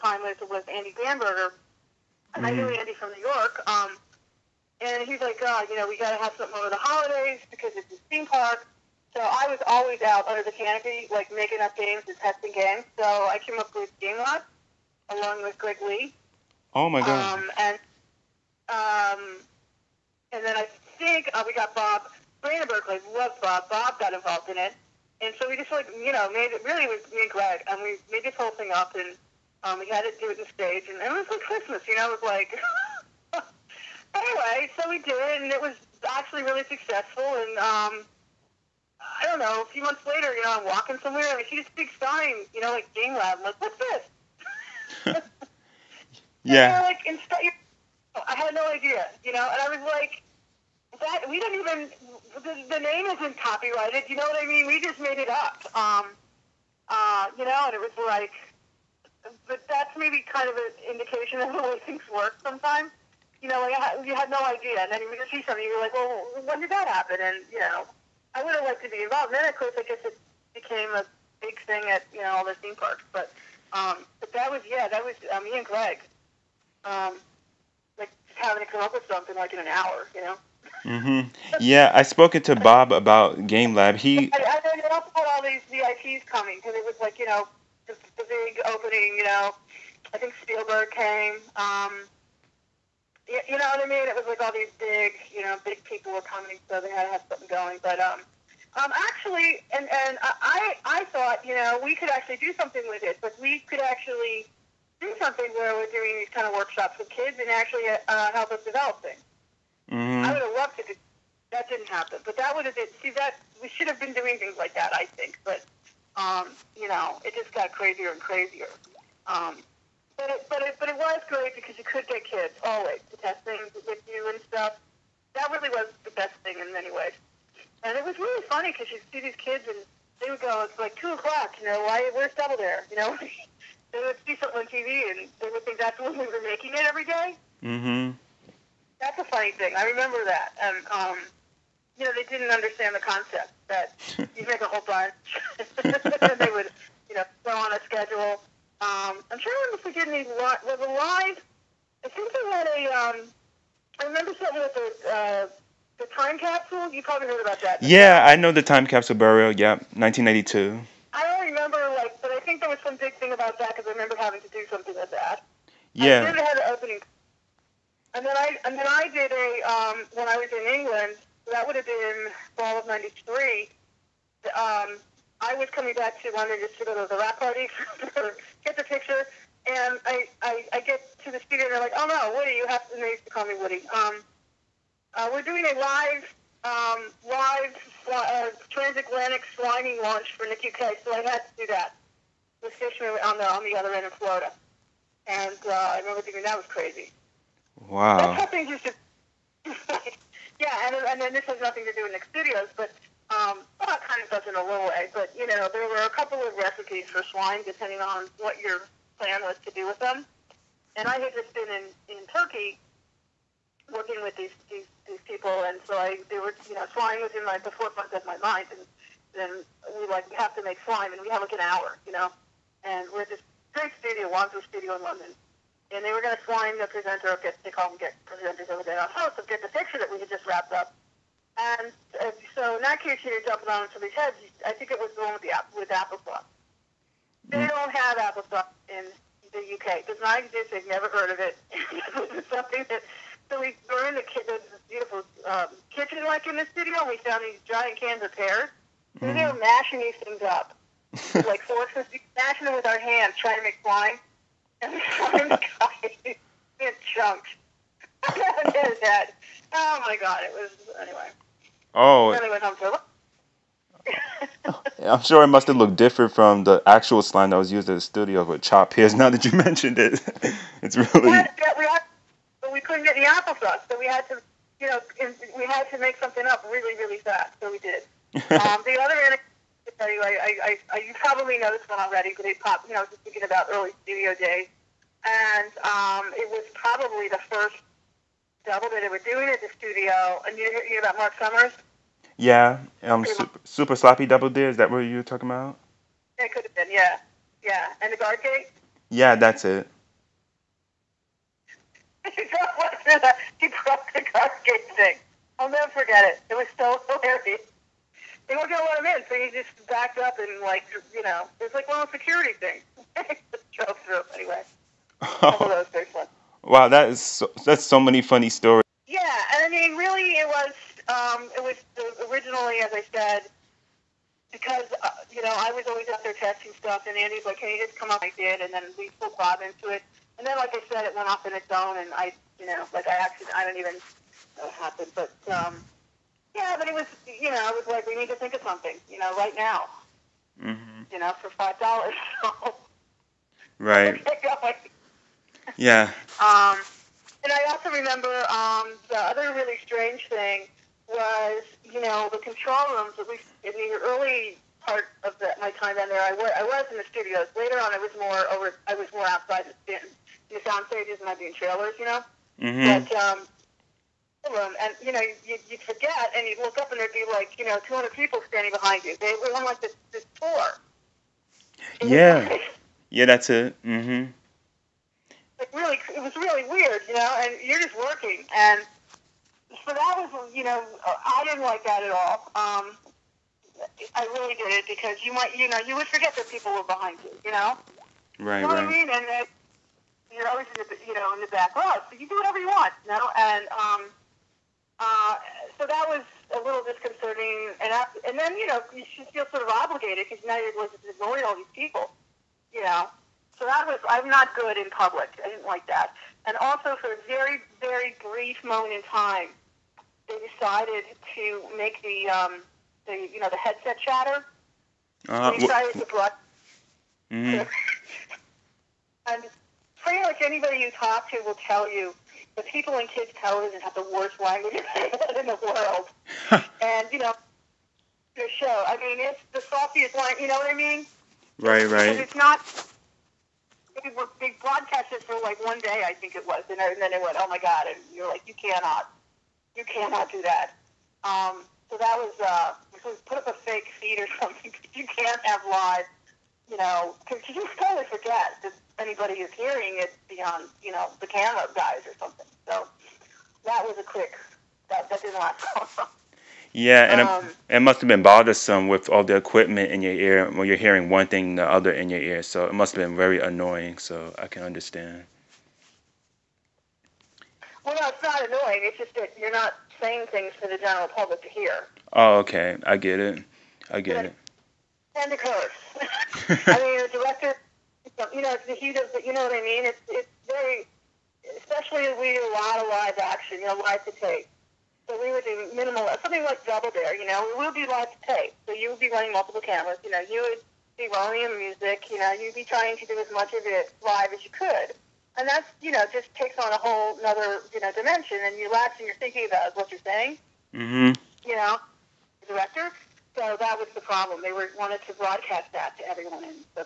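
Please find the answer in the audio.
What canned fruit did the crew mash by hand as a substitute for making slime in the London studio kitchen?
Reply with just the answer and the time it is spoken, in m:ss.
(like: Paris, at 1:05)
Pears, at 4:08.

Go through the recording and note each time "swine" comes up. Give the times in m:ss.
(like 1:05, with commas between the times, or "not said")
3:27, 3:36.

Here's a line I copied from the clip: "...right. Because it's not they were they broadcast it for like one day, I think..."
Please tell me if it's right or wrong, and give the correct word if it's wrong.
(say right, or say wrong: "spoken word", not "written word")
right.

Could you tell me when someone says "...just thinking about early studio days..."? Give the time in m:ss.
4:43.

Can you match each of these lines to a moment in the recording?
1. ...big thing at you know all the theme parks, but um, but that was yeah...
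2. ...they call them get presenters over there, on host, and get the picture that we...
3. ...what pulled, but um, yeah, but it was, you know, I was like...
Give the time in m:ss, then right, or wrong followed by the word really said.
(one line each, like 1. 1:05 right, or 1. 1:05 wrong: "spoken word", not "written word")
1. 1:11 right
2. 3:47 right
3. 5:34 wrong: "happened", not "pulled".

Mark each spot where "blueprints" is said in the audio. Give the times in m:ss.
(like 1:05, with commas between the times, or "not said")
not said.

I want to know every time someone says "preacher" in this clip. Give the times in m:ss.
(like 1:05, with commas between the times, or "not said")
not said.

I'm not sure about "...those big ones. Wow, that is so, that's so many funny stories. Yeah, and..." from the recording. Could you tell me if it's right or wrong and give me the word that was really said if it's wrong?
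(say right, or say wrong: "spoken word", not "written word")
right.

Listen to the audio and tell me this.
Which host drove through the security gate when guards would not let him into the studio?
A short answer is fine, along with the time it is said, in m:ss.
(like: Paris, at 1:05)
Mark Summers, at 4:51.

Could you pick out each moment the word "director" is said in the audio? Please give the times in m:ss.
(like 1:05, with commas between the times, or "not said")
7:57, 8:22.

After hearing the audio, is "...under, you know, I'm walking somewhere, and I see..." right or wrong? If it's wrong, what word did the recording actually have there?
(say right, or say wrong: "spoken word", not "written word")
wrong: "later", not "under".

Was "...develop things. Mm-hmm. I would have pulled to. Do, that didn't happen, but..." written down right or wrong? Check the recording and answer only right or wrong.
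wrong.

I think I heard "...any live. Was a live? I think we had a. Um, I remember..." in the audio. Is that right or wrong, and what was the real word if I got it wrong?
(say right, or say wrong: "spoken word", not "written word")
right.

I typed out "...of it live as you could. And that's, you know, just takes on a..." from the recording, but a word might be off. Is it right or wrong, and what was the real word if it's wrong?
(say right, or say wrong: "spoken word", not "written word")
right.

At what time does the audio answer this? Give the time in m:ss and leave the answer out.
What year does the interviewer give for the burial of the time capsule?
2:39.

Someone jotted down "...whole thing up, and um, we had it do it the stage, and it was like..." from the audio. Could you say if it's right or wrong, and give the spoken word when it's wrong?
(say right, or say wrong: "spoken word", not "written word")
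right.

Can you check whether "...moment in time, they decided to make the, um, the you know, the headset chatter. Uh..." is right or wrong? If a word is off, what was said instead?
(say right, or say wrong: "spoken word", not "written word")
right.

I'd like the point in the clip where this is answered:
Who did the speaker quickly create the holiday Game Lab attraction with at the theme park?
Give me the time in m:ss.
0:15.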